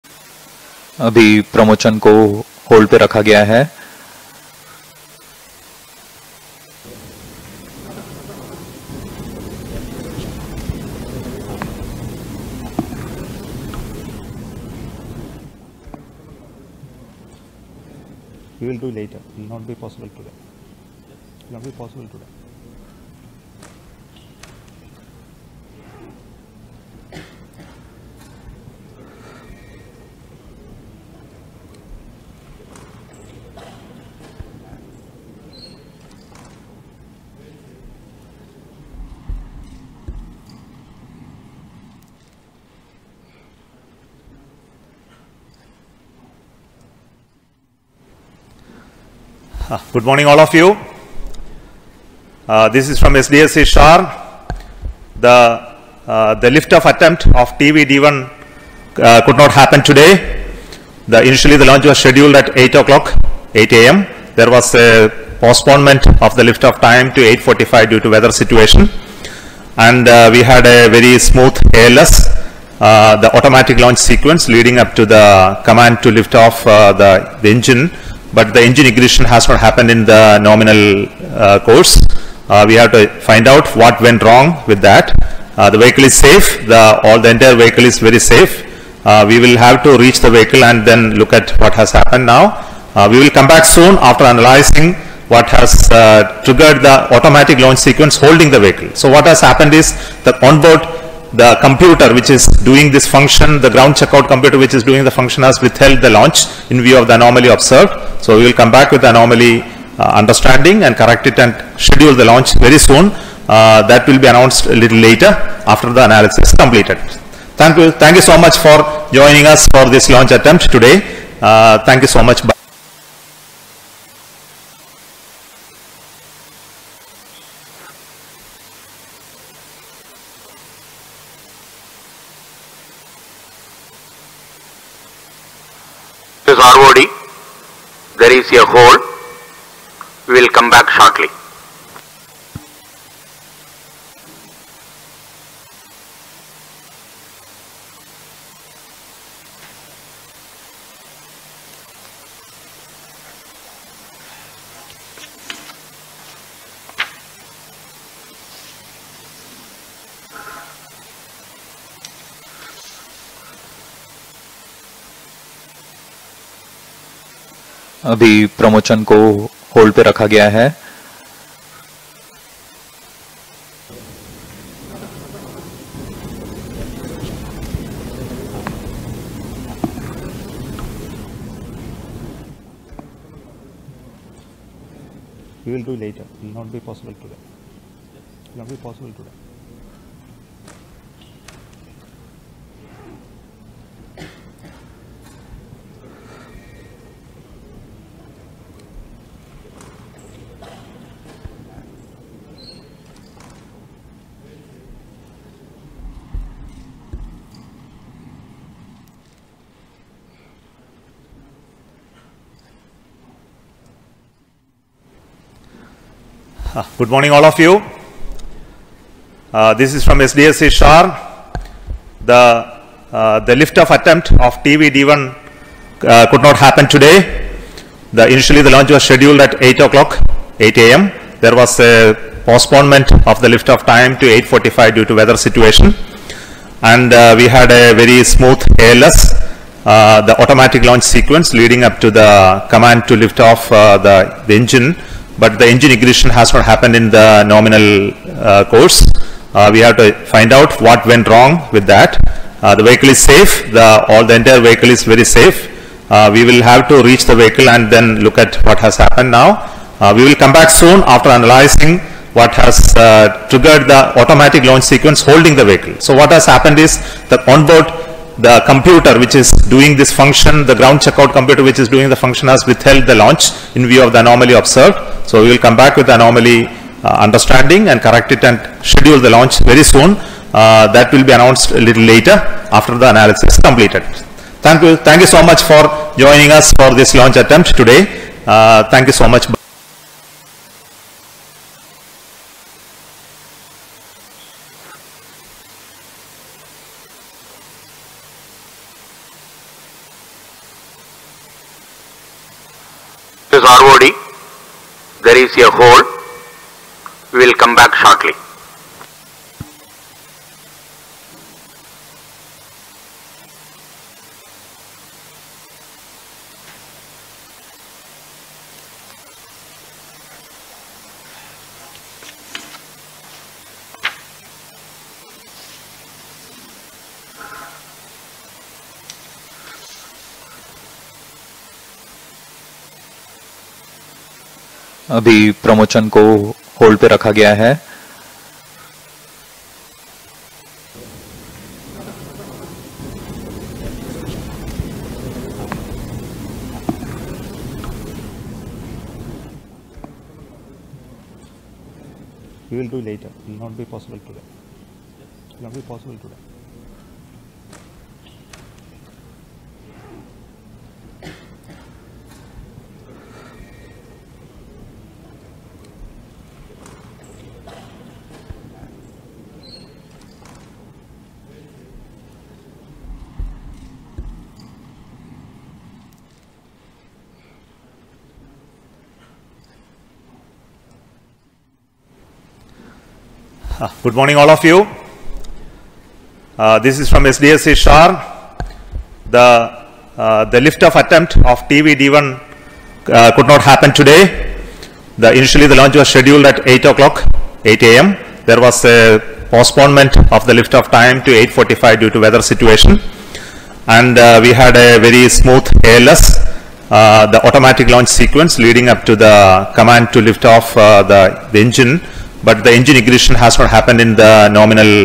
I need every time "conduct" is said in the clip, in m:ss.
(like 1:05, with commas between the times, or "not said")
not said.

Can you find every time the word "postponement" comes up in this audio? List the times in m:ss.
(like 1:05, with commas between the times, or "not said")
1:05, 3:52, 6:39.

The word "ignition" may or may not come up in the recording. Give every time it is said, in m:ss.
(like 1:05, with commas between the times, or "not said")
1:18, 4:05, 6:52.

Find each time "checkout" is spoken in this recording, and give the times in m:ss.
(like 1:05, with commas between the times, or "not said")
1:43, 4:30.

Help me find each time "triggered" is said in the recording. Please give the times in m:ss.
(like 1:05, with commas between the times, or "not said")
1:36, 4:23.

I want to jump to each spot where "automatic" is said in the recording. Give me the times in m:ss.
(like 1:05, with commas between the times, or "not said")
1:13, 1:37, 4:00, 4:24, 6:47.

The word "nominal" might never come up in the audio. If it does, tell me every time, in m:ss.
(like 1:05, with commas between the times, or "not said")
1:20, 4:07, 6:54.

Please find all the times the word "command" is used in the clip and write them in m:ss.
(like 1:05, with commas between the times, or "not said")
1:15, 4:02, 6:49.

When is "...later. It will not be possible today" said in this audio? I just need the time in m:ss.
3:06.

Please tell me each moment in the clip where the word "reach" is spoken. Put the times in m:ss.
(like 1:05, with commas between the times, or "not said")
1:29, 4:17.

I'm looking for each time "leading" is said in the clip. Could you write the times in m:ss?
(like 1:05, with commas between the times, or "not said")
1:14, 4:01, 6:48.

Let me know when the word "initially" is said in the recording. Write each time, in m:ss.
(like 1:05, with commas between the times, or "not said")
1:01, 3:48, 6:35.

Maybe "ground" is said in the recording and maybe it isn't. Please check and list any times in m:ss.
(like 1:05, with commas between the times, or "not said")
1:43, 4:30.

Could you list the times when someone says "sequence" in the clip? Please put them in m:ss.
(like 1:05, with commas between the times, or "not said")
1:13, 1:37, 4:01, 4:24, 6:48.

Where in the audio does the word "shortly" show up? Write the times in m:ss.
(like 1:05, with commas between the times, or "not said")
2:20, 5:08.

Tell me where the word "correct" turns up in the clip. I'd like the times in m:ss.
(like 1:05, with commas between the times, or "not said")
1:50, 4:38.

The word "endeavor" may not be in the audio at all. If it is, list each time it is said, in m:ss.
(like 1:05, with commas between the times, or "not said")
not said.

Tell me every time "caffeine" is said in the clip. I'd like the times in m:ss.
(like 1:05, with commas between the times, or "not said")
not said.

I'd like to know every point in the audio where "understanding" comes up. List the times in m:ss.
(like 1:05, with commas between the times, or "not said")
1:50, 4:37.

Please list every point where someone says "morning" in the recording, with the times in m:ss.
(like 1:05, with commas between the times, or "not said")
0:50, 3:37, 6:24.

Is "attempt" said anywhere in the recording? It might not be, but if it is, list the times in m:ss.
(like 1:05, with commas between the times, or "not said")
0:56, 2:00, 3:43, 4:47, 6:30.